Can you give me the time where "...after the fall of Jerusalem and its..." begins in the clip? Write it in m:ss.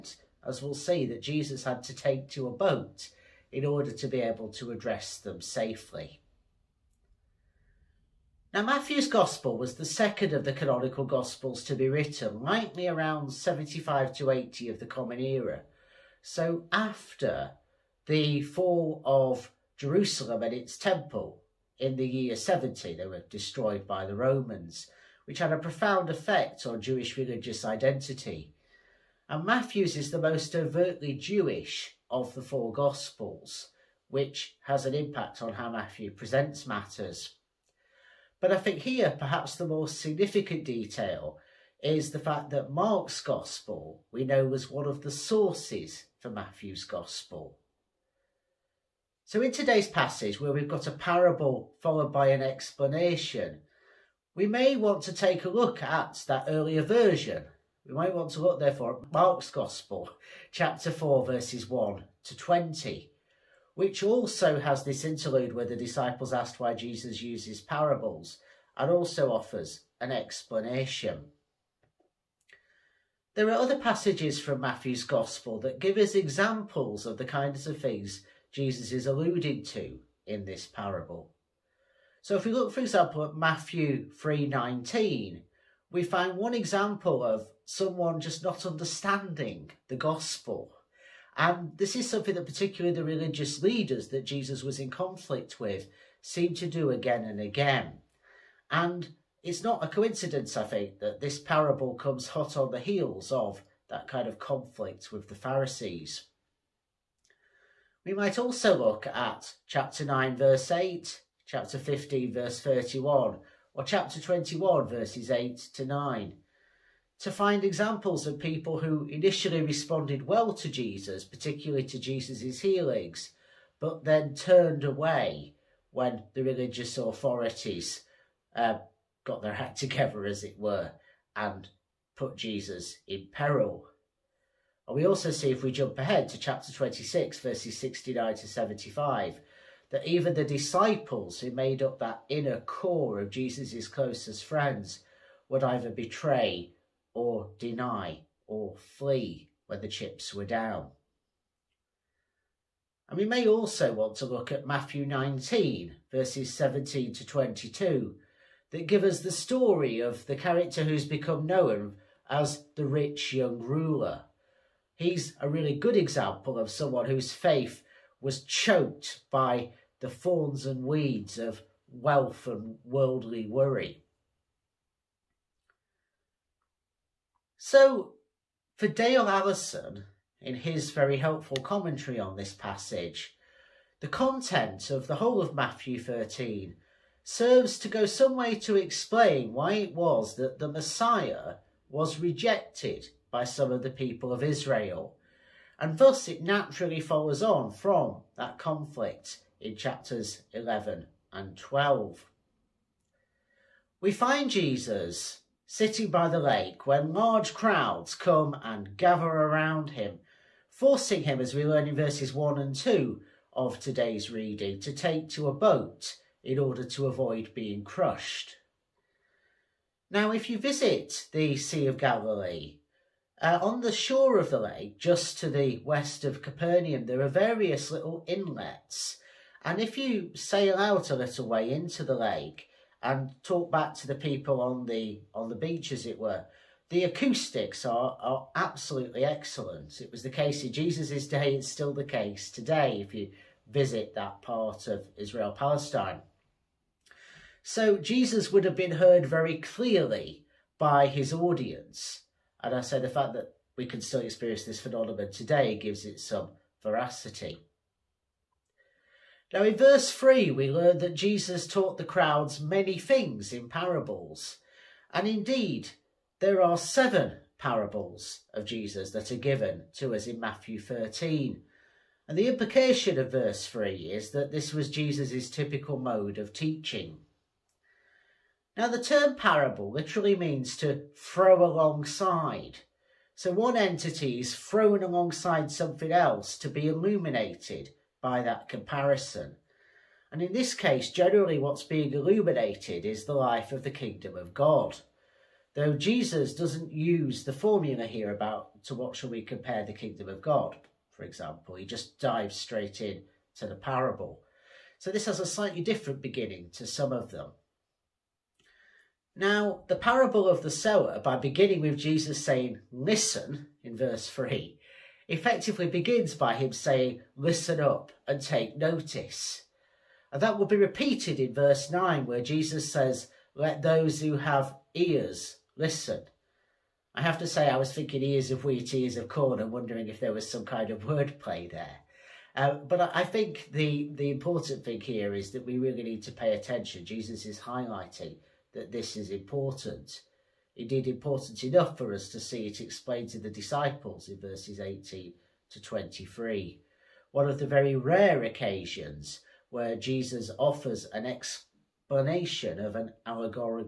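0:16.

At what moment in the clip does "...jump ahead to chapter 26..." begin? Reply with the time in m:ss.
2:15.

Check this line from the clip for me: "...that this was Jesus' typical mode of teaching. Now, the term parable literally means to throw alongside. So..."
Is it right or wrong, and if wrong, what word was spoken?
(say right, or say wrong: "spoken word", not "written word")
right.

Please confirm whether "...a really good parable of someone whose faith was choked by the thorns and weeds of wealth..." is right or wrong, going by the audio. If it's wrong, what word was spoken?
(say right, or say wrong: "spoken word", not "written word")
wrong: "example", not "parable".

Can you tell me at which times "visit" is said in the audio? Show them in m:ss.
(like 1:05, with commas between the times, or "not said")
3:40, 4:03.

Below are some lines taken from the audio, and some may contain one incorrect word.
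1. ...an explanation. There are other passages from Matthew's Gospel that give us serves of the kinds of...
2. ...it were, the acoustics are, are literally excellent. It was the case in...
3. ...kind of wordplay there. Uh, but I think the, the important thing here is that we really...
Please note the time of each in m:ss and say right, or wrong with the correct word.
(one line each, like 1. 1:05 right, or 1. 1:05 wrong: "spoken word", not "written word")
1. 1:09 wrong: "examples", not "serves"
2. 3:56 wrong: "absolutely", not "literally"
3. 5:30 right.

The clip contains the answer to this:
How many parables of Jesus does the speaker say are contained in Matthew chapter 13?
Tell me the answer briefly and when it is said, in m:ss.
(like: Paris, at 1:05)
7, at 4:26.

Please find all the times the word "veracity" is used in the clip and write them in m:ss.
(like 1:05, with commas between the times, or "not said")
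4:16.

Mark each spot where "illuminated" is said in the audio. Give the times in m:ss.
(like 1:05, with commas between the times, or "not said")
4:46, 4:52.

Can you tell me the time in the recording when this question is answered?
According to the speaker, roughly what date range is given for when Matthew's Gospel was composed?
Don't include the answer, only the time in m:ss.
0:13.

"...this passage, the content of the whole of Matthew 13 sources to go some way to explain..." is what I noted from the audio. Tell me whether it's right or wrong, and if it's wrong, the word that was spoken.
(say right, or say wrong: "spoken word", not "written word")
wrong: "serves", not "sources".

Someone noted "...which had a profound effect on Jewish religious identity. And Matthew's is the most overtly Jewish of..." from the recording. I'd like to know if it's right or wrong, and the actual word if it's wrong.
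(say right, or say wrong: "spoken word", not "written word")
right.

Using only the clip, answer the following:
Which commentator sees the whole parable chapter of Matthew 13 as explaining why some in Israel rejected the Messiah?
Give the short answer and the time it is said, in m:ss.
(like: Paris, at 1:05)
Dale Allison, at 2:58.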